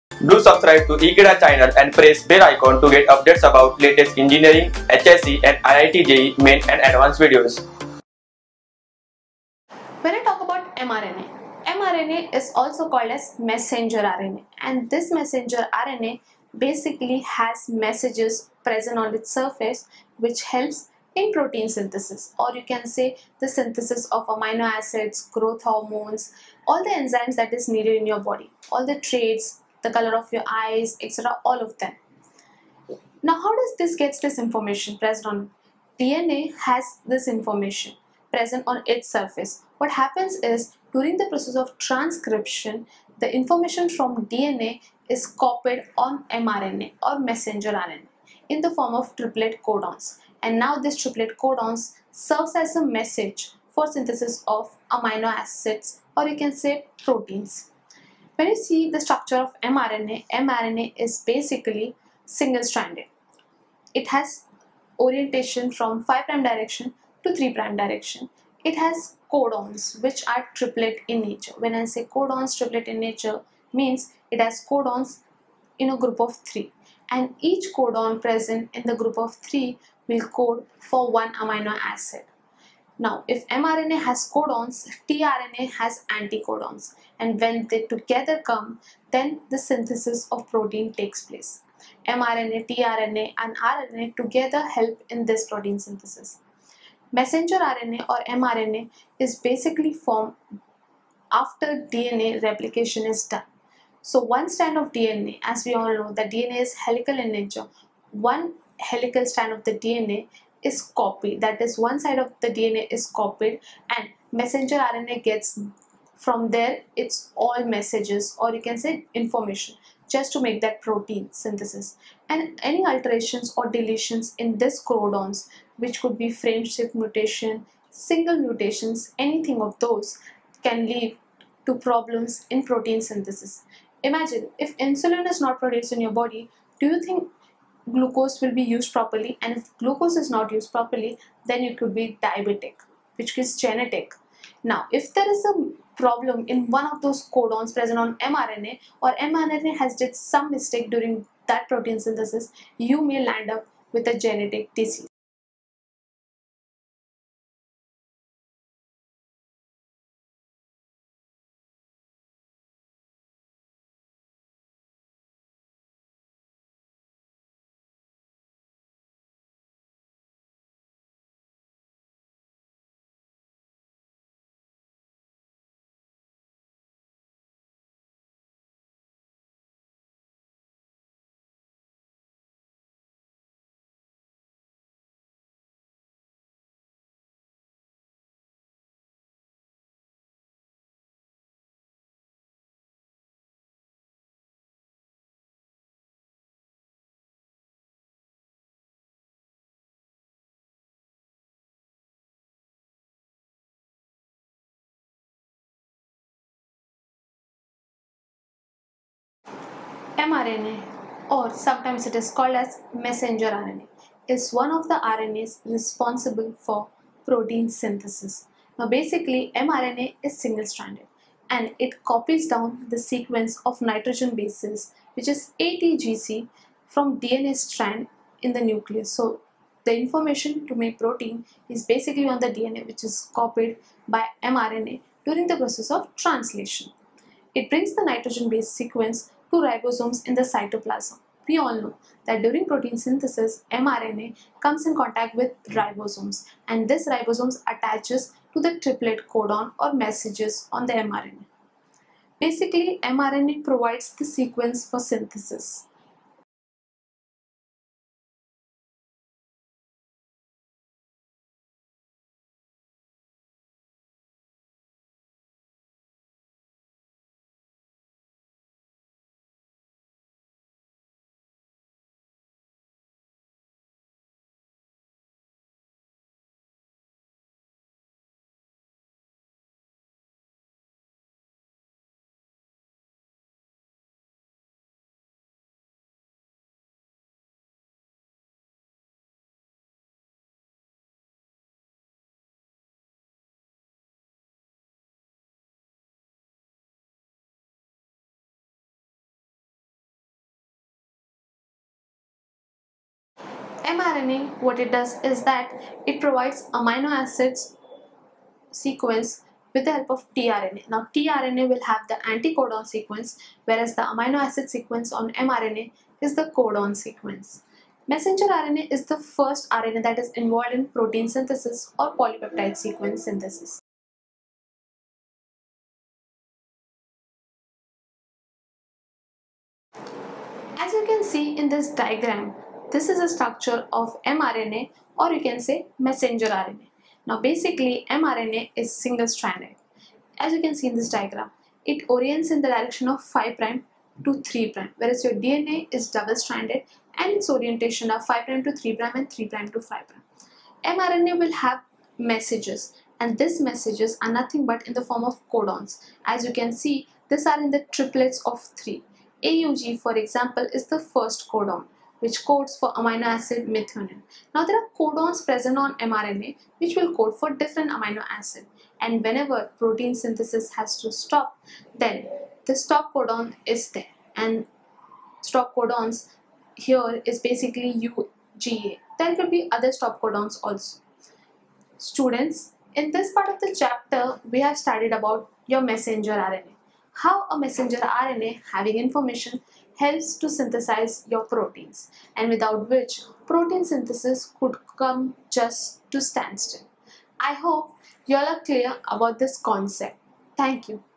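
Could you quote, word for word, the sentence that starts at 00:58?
When you see the structure of mRNA, mRNA is basically single-stranded.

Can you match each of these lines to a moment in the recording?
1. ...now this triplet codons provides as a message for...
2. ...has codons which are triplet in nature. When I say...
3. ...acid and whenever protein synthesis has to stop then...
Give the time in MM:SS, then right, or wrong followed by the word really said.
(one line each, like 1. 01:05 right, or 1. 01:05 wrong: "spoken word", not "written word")
1. 00:50 wrong: "serves", not "provides"
2. 01:08 right
3. 06:08 right.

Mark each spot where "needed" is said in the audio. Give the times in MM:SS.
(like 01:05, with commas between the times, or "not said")
00:27.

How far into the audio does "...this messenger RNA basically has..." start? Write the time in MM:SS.
00:14.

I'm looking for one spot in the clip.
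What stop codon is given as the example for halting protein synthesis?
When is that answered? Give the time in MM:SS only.
06:18.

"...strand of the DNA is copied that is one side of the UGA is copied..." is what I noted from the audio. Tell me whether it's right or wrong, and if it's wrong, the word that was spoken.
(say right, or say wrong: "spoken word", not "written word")
wrong: "DNA", not "UGA".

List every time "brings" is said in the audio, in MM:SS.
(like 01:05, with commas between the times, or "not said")
03:57.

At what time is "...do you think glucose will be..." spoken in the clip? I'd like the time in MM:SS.
02:16.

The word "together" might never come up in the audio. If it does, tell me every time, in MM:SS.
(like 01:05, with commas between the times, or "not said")
01:27, 01:34.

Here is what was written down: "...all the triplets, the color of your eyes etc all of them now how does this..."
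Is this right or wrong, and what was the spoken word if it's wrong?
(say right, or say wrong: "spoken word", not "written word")
wrong: "traits", not "triplets".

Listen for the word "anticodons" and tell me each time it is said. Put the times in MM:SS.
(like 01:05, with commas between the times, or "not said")
01:26, 05:12.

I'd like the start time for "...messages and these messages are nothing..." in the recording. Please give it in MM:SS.
05:52.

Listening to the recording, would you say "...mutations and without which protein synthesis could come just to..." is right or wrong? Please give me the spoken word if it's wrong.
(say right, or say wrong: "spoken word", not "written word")
wrong: "proteins", not "mutations".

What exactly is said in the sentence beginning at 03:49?
So the information to make protein is basically on the DNA which is copied by mRNA during the process of translation.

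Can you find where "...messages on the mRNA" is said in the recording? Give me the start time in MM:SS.
04:09.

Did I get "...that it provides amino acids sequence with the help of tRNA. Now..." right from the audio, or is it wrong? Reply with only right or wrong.
right.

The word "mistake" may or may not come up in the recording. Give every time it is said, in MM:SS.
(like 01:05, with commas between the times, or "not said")
02:30.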